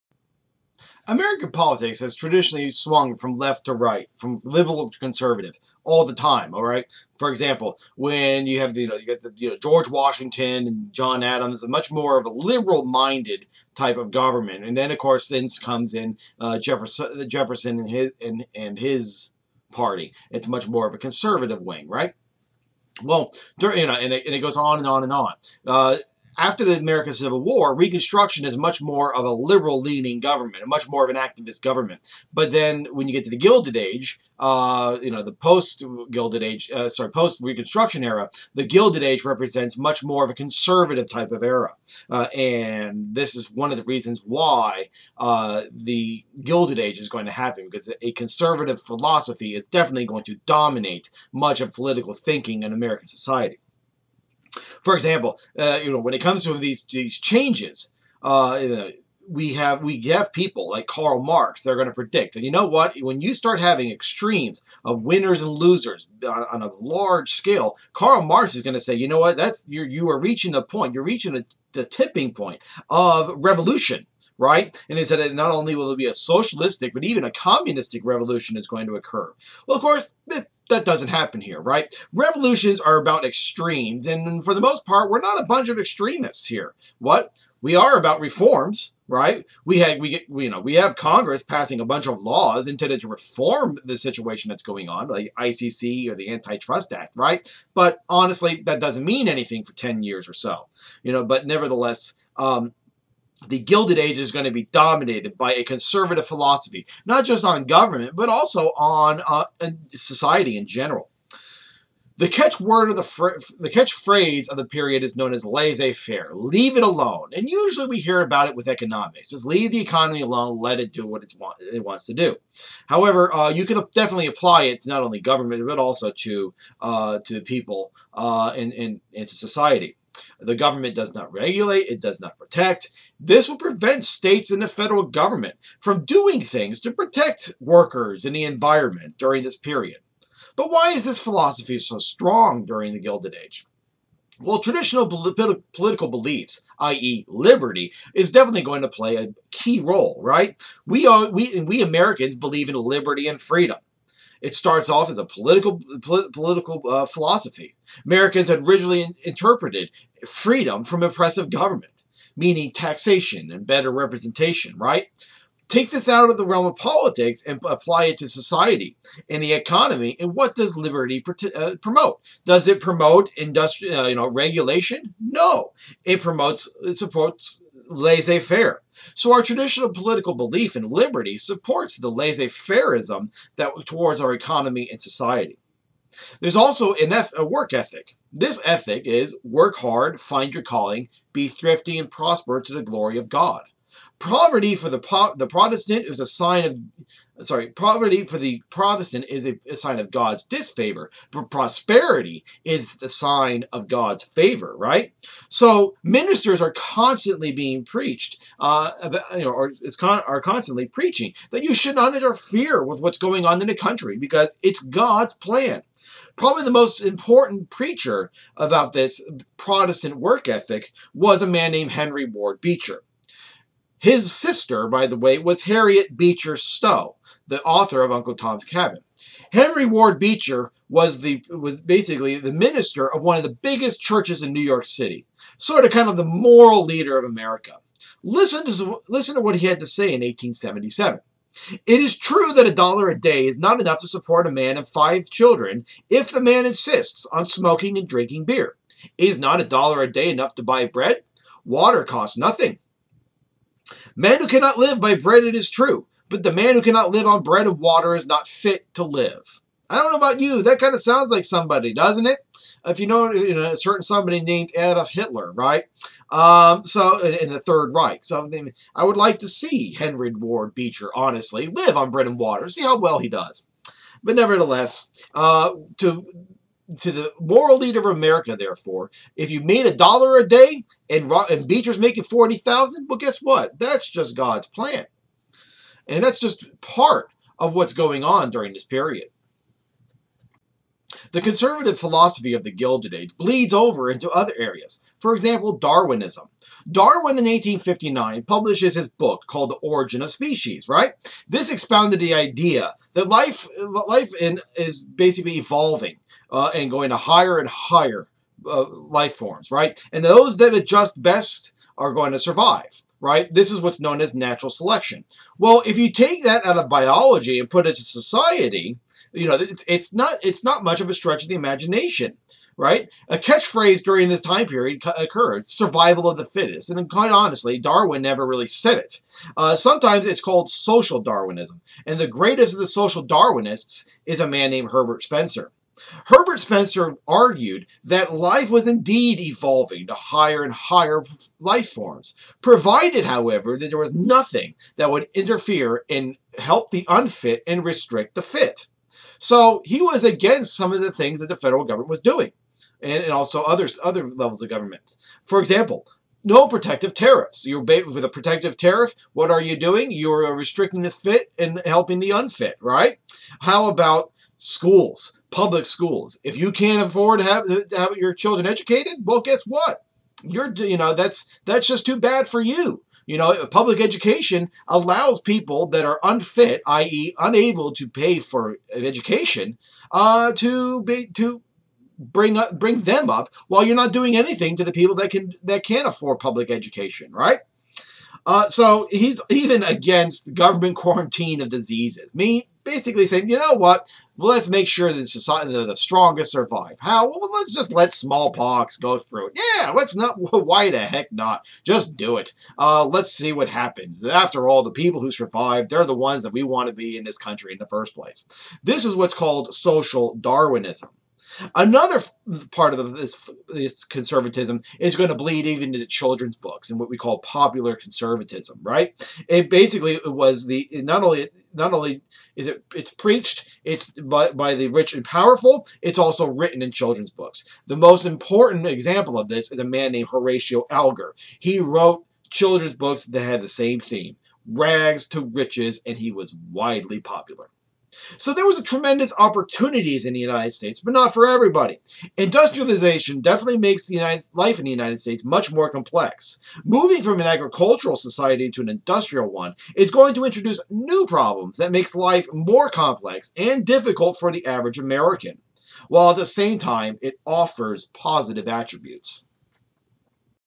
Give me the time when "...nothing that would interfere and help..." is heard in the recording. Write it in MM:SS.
05:44.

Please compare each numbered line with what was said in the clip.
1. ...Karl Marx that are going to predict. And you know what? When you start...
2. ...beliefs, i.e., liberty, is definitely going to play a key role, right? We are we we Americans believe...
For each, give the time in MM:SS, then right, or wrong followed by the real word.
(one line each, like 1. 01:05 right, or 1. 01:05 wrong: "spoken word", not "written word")
1. 01:00 right
2. 02:26 right.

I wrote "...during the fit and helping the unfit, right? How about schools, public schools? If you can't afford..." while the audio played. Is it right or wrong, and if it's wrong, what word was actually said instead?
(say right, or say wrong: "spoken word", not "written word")
wrong: "restricting", not "during".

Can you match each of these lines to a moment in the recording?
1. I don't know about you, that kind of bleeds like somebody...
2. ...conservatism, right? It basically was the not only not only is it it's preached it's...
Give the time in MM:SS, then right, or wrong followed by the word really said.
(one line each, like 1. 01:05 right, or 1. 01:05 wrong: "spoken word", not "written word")
1. 04:19 wrong: "sounds", not "bleeds"
2. 06:57 right.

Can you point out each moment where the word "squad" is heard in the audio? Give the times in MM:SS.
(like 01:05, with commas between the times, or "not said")
not said.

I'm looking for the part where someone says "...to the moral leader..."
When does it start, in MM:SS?
04:36.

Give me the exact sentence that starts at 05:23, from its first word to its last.
A catchphrase during this time period occurred: "Survival of the fittest." And quite honestly, Darwin never really said it.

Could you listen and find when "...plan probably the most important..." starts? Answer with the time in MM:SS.
03:35.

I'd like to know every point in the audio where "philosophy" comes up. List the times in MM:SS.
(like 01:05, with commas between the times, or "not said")
00:48, 01:46, 02:21, 02:37, 04:51.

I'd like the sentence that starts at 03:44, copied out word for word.
His sister, by the way, was Harriet Beecher Stowe, the author of Uncle Tom's Cabin.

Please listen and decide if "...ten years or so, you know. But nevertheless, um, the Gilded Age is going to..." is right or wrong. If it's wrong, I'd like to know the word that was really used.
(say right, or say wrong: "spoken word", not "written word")
right.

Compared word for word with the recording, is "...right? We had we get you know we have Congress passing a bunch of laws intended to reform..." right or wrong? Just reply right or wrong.
right.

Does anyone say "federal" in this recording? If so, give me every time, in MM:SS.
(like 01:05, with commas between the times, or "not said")
02:14, 05:51.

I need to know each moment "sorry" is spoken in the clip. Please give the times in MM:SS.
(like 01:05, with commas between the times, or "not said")
00:36, 03:17.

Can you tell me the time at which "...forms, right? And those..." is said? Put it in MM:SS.
05:09.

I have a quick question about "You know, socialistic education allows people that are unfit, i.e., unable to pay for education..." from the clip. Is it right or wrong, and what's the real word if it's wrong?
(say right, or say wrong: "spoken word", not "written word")
wrong: "public", not "socialistic".